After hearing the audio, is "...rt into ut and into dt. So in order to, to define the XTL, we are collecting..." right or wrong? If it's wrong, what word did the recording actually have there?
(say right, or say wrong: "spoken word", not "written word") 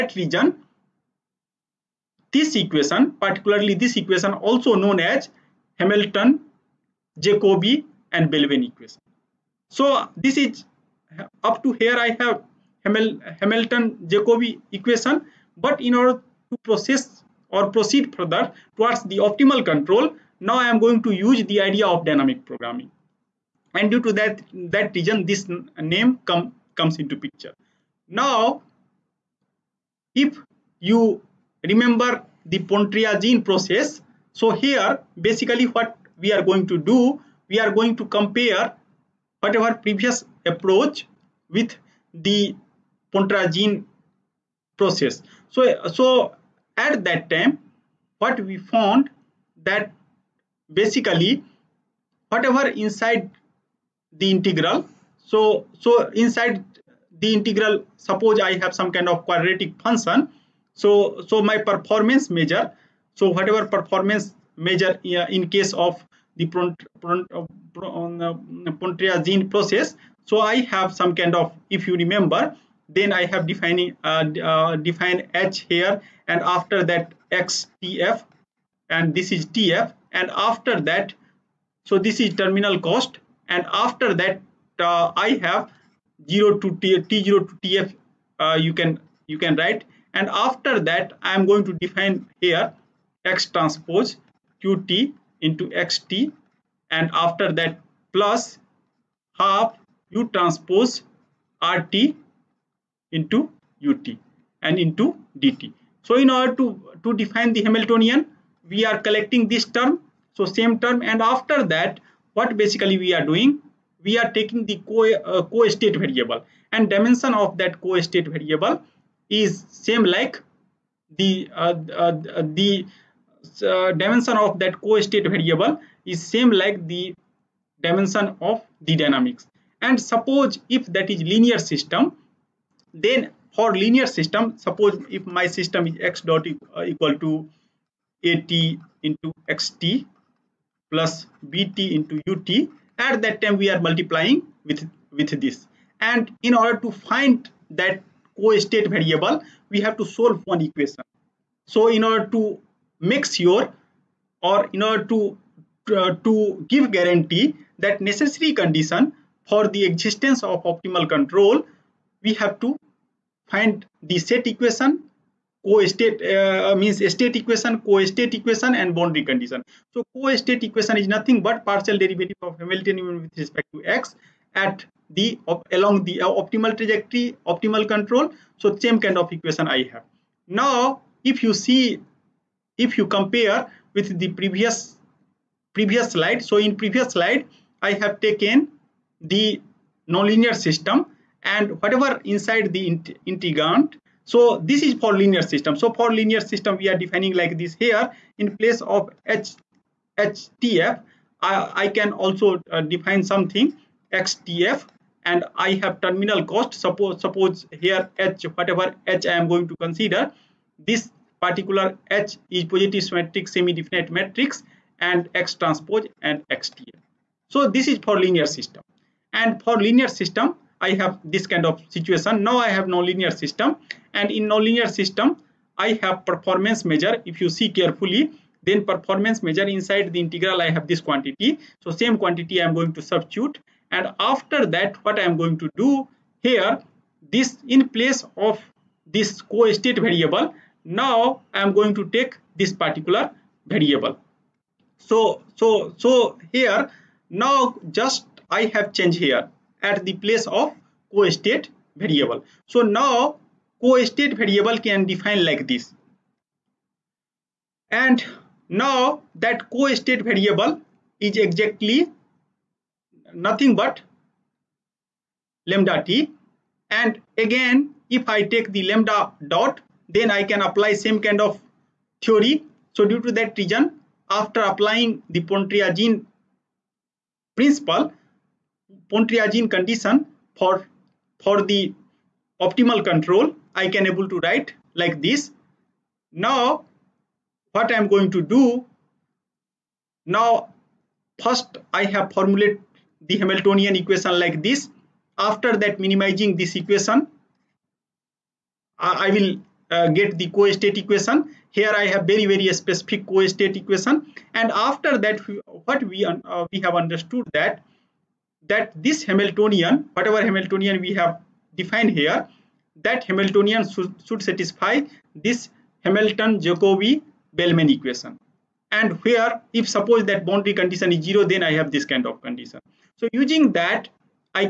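wrong: "Hamiltonian", not "XTL".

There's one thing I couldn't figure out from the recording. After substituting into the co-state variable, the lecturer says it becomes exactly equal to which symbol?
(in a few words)
lambda t.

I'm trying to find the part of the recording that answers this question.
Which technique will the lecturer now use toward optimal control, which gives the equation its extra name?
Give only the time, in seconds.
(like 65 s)
22 s.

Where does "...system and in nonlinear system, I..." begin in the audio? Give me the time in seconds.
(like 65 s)
223 s.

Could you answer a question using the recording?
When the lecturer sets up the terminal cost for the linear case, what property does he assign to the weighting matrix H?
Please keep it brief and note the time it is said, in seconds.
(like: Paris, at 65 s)
positive symmetric semi-definite, at 212 s.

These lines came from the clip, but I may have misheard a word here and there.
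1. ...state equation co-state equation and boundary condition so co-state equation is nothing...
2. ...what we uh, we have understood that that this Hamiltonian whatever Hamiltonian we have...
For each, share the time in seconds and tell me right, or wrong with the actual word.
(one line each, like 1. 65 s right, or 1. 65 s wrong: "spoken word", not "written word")
1. 167 s right
2. 305 s right.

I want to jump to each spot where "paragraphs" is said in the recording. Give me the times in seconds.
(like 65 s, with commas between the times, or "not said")
not said.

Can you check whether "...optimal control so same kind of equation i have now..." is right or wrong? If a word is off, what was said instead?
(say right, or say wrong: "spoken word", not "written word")
right.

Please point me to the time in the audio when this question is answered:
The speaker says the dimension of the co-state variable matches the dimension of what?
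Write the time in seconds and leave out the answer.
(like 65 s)
127 s.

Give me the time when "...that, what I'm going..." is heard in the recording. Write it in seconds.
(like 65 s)
234 s.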